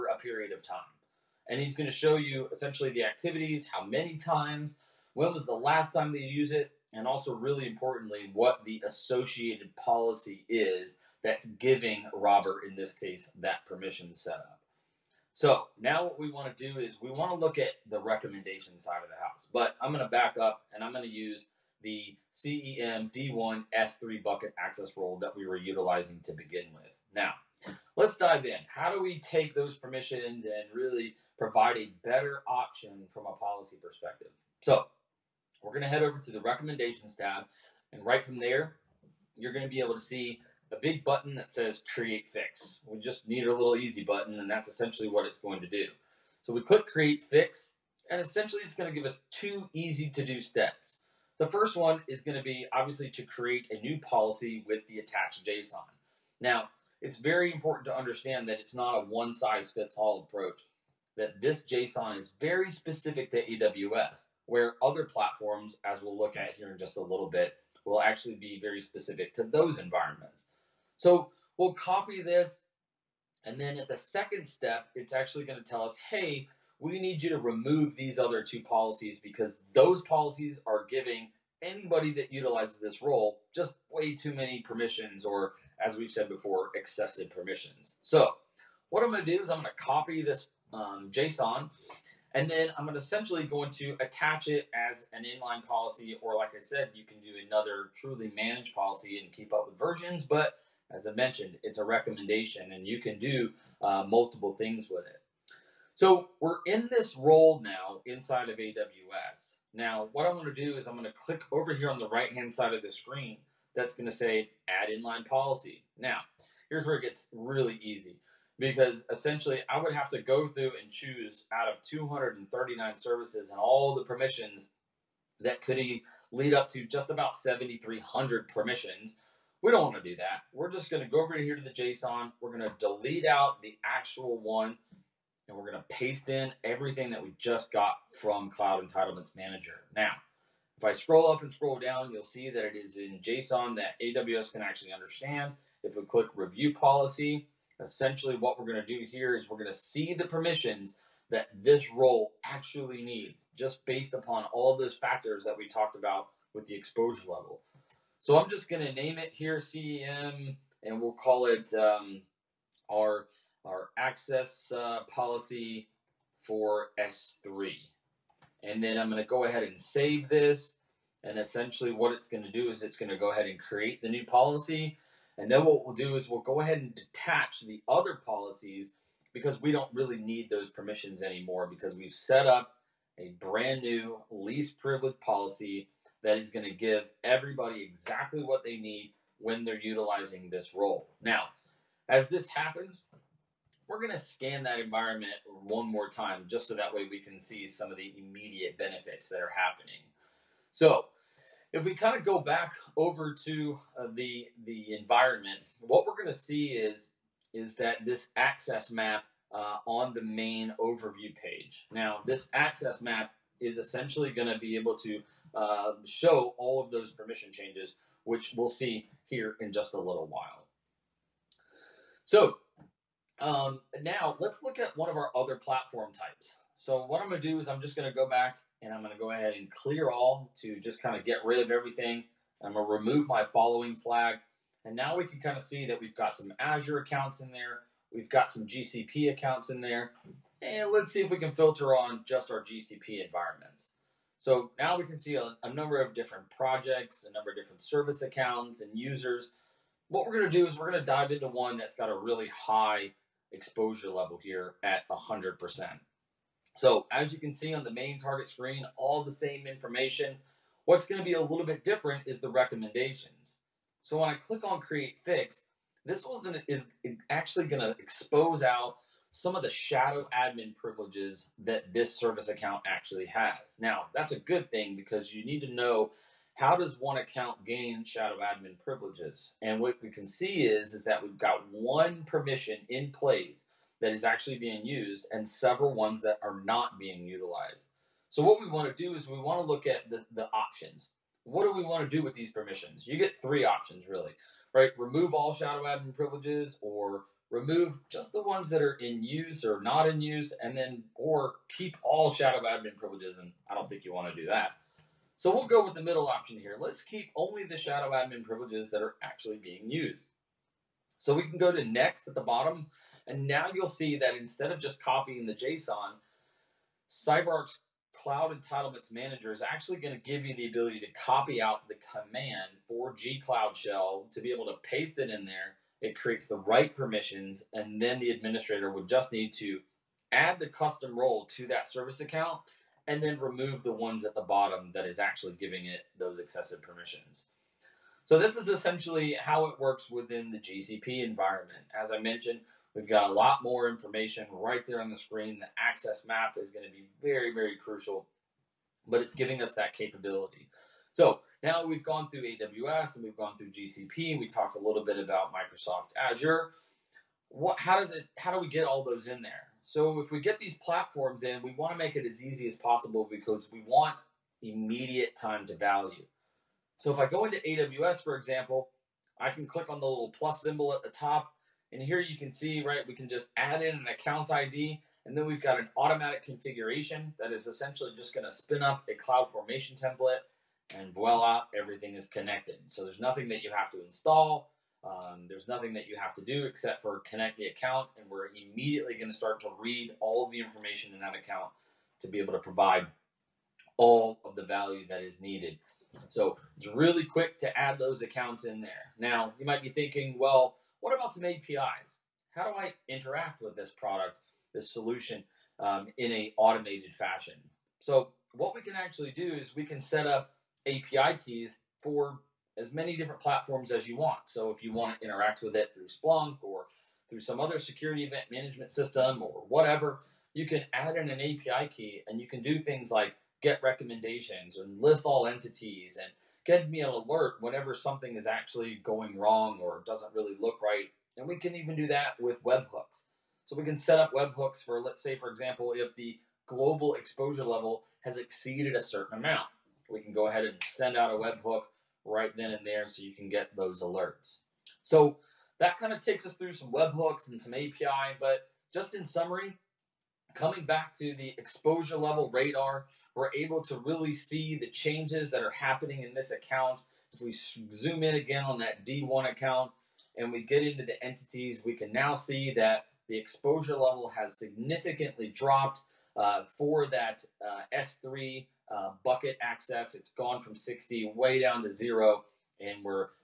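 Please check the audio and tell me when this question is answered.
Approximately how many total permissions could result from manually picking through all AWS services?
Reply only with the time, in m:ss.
2:07.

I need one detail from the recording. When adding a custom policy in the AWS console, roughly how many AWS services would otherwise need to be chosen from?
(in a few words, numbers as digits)
239.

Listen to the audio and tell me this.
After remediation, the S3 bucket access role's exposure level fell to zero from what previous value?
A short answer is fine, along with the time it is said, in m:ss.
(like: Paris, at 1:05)
60, at 7:50.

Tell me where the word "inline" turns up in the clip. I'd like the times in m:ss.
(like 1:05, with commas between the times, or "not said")
1:35, 1:54.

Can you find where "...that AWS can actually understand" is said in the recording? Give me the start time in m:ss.
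2:23.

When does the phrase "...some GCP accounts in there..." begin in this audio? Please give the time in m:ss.
3:58.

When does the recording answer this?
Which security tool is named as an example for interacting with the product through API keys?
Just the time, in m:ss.
6:56.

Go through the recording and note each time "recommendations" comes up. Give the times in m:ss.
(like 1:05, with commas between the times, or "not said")
0:17, 0:36, 1:41, 4:22, 7:03.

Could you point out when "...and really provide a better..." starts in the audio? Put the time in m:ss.
0:30.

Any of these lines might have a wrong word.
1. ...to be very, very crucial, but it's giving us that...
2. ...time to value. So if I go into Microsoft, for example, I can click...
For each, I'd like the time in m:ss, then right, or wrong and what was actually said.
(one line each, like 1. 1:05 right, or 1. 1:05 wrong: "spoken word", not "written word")
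1. 5:46 right
2. 6:05 wrong: "AWS", not "Microsoft".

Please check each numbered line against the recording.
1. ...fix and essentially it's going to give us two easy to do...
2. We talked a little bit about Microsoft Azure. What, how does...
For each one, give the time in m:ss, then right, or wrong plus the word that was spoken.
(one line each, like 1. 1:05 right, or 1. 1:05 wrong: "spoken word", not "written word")
1. 0:47 right
2. 5:54 right.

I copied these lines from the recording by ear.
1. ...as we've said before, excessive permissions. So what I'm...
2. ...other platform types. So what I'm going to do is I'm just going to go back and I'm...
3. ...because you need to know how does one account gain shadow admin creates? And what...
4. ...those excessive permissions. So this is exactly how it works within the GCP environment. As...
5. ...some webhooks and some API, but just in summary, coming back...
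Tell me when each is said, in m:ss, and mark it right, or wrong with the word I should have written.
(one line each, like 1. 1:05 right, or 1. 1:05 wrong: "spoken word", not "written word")
1. 1:25 right
2. 3:45 right
3. 4:34 wrong: "privileges", not "creates"
4. 5:36 wrong: "essentially", not "exactly"
5. 7:26 right.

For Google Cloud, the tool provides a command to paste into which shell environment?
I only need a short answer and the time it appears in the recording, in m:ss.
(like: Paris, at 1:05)
G Cloud Shell, at 5:23.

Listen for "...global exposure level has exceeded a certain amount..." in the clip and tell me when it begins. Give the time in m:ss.
7:16.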